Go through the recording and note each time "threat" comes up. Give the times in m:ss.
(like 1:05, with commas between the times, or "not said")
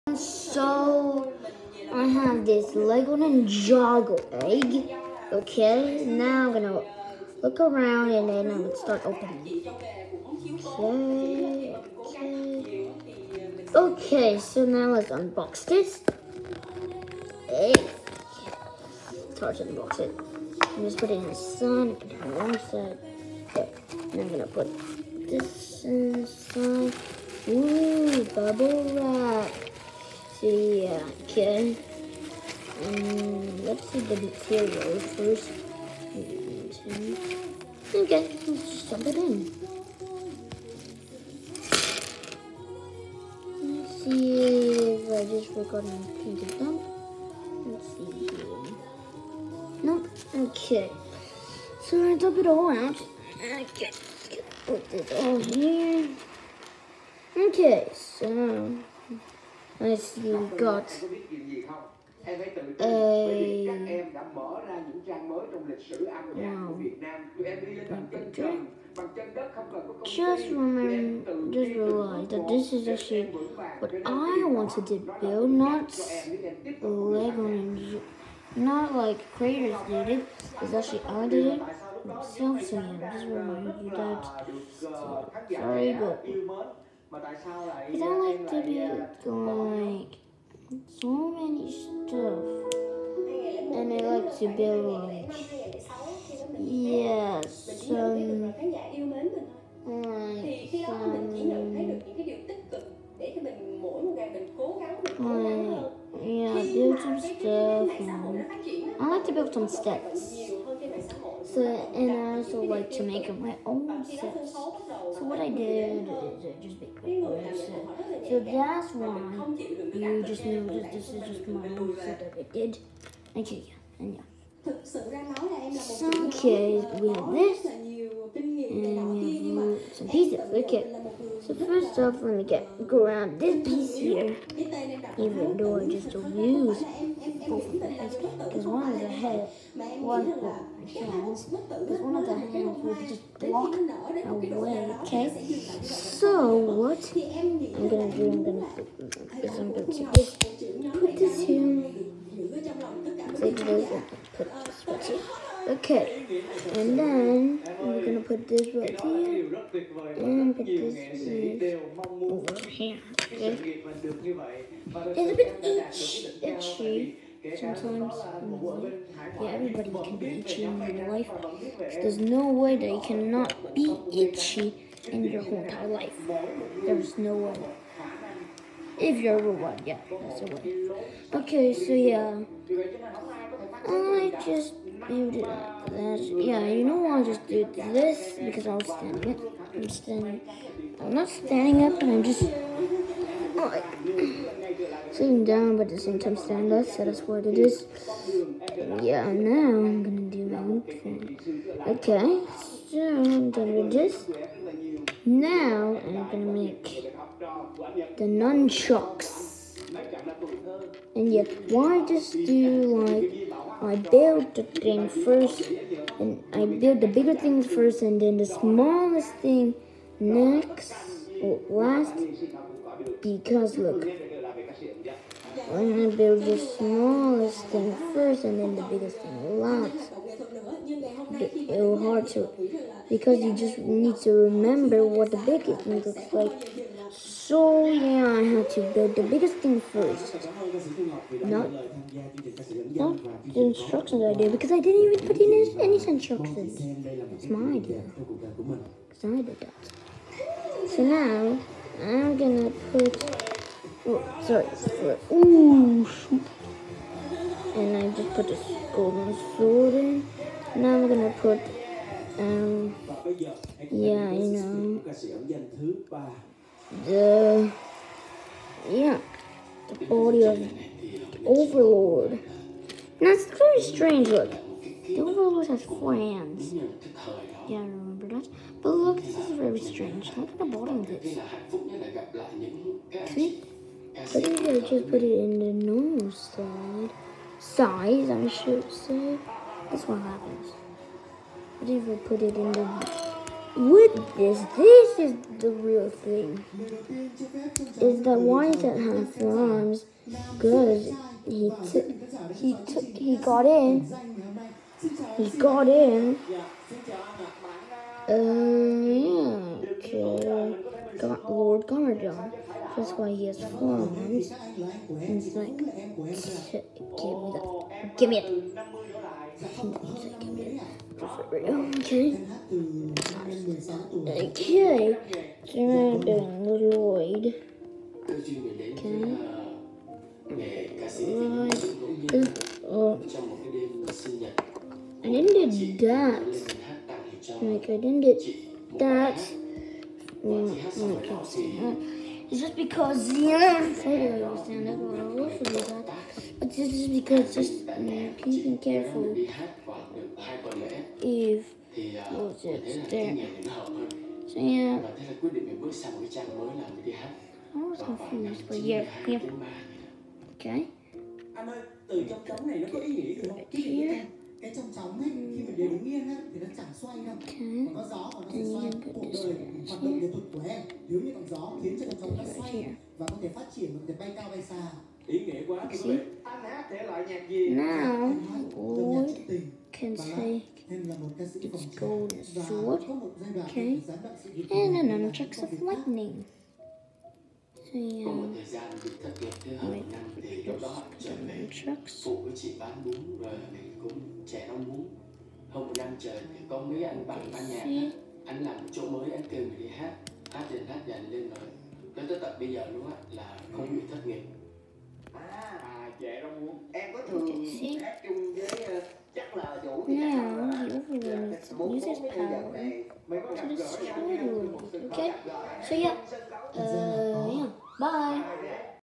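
not said.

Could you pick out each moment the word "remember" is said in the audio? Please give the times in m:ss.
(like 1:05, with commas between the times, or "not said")
1:10, 3:54, 4:37.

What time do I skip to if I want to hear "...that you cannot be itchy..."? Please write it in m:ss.
2:52.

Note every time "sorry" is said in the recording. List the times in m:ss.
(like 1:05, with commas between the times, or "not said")
1:25, 4:14.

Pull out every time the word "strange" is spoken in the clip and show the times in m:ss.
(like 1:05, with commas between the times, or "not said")
4:33, 4:39.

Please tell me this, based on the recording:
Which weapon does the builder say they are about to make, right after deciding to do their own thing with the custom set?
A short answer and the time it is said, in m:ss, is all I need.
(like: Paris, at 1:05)
Nunchucks, at 3:28.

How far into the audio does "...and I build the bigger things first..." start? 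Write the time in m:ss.
3:36.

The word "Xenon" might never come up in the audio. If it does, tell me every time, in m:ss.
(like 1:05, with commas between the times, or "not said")
5:43.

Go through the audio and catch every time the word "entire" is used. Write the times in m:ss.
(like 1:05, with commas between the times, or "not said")
2:55.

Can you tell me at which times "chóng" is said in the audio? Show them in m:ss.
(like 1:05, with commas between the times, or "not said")
6:04, 6:12.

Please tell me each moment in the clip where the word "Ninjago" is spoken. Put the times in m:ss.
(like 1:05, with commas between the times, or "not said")
0:03.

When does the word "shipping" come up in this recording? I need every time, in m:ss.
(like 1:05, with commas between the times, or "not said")
not said.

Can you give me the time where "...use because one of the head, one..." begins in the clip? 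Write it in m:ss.
2:16.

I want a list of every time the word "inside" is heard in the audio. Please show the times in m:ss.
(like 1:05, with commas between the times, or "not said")
0:25.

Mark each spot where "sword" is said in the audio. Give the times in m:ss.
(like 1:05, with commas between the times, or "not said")
4:19, 6:22.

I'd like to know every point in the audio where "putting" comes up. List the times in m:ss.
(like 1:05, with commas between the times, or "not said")
0:20.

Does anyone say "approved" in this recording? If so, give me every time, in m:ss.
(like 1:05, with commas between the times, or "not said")
not said.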